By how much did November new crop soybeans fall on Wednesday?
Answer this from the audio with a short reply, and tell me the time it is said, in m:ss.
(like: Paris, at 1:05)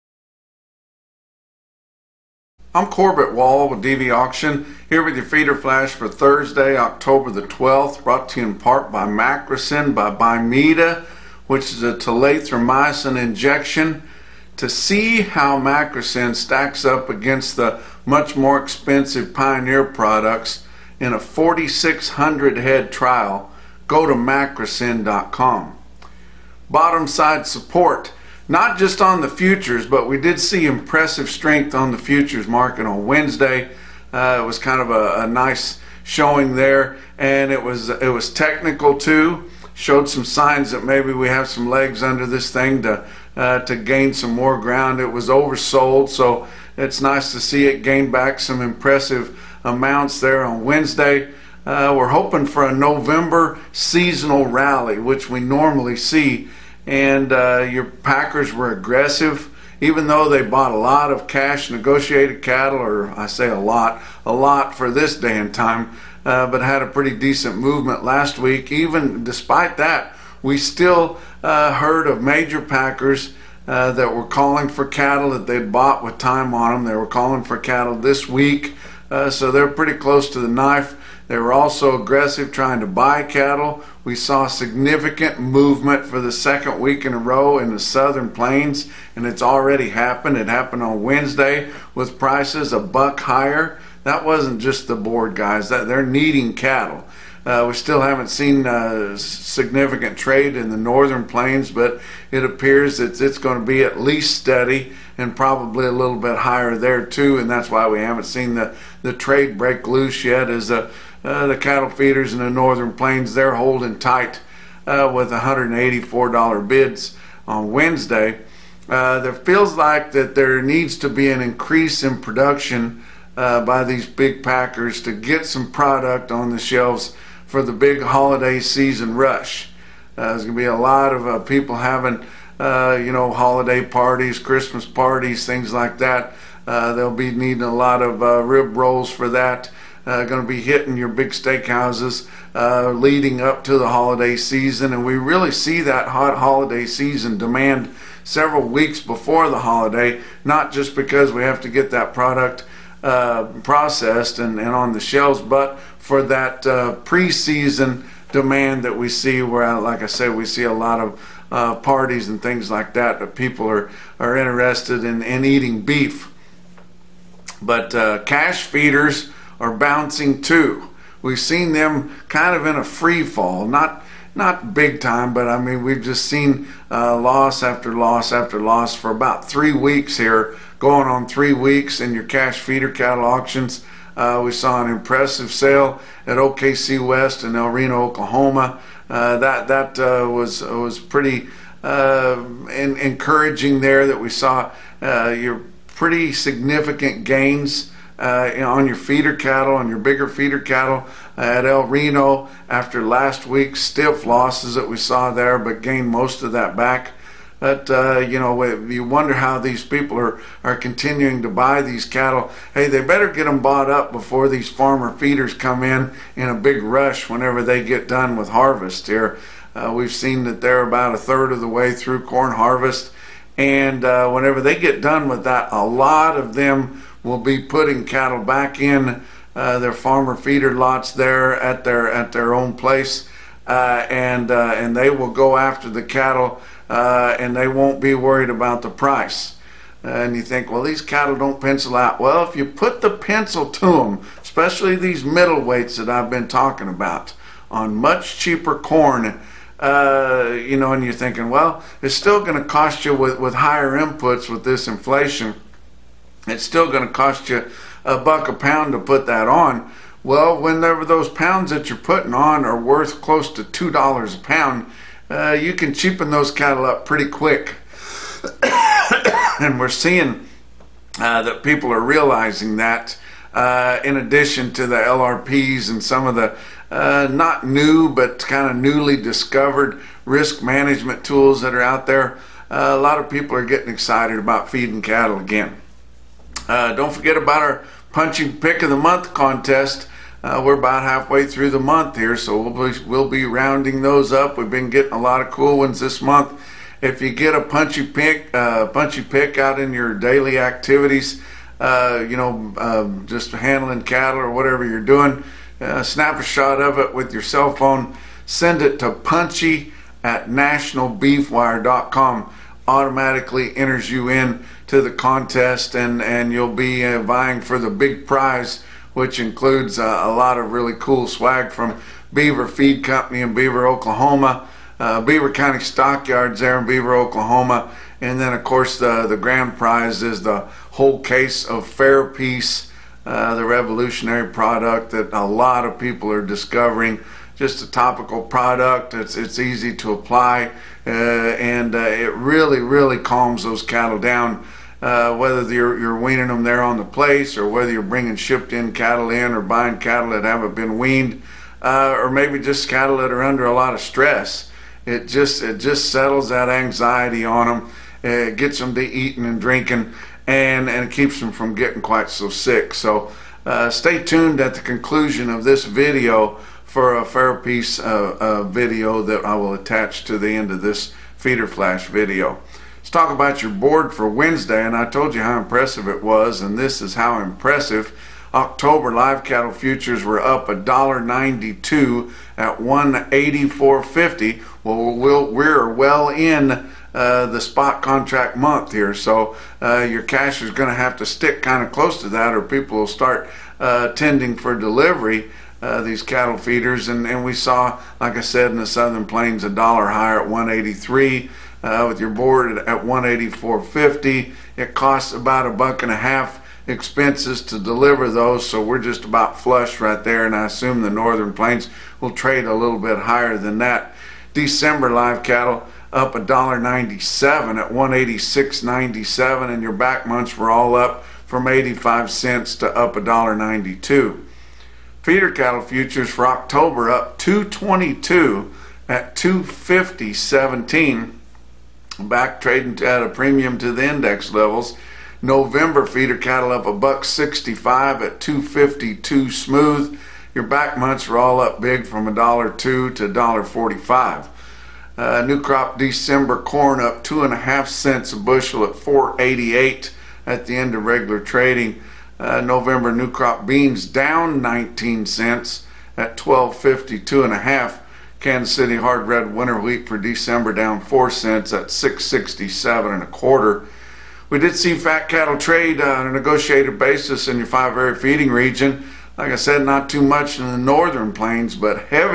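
19 cents, at 7:34.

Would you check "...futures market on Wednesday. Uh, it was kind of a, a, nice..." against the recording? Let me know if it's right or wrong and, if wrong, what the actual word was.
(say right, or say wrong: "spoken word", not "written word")
right.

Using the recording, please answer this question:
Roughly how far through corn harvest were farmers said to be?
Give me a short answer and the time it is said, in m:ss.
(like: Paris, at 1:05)
a third, at 3:41.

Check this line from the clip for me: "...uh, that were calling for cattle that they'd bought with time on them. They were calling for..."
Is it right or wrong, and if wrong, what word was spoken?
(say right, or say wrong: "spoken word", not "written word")
right.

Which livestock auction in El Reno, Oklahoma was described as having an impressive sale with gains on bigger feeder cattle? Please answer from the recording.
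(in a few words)
OKC West.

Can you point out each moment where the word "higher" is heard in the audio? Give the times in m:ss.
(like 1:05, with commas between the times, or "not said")
1:33, 1:46, 4:13, 6:40, 6:53.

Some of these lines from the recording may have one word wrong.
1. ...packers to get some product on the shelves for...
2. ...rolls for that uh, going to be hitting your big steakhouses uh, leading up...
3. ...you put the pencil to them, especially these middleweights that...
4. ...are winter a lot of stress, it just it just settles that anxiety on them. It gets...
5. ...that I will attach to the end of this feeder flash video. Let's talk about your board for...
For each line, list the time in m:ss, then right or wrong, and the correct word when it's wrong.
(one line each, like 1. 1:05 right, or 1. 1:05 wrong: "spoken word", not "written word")
1. 2:04 right
2. 2:18 right
3. 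4:02 right
4. 5:53 wrong: "under", not "winter"
5. 6:09 right.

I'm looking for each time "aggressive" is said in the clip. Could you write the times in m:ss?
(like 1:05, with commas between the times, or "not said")
0:58, 1:21.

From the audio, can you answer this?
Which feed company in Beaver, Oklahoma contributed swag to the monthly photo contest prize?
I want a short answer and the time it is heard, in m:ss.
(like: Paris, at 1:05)
Beaver Feed Company, at 5:22.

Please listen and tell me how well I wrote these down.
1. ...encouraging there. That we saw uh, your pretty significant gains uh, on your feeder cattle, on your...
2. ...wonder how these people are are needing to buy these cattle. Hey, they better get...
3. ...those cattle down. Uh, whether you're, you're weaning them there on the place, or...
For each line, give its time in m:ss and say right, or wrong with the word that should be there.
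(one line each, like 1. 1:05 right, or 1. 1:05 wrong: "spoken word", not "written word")
1. 3:12 right
2. 3:29 wrong: "continuing", not "needing"
3. 5:43 right.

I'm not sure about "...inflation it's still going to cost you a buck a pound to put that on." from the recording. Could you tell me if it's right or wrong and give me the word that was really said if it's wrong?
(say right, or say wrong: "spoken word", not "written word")
right.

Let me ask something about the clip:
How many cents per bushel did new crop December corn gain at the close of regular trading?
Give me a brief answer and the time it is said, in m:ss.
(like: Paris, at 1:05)
2.5 cents, at 7:27.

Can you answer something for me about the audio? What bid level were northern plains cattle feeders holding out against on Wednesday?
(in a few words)
$184.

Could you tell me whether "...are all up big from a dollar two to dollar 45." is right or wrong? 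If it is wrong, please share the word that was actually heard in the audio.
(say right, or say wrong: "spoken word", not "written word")
right.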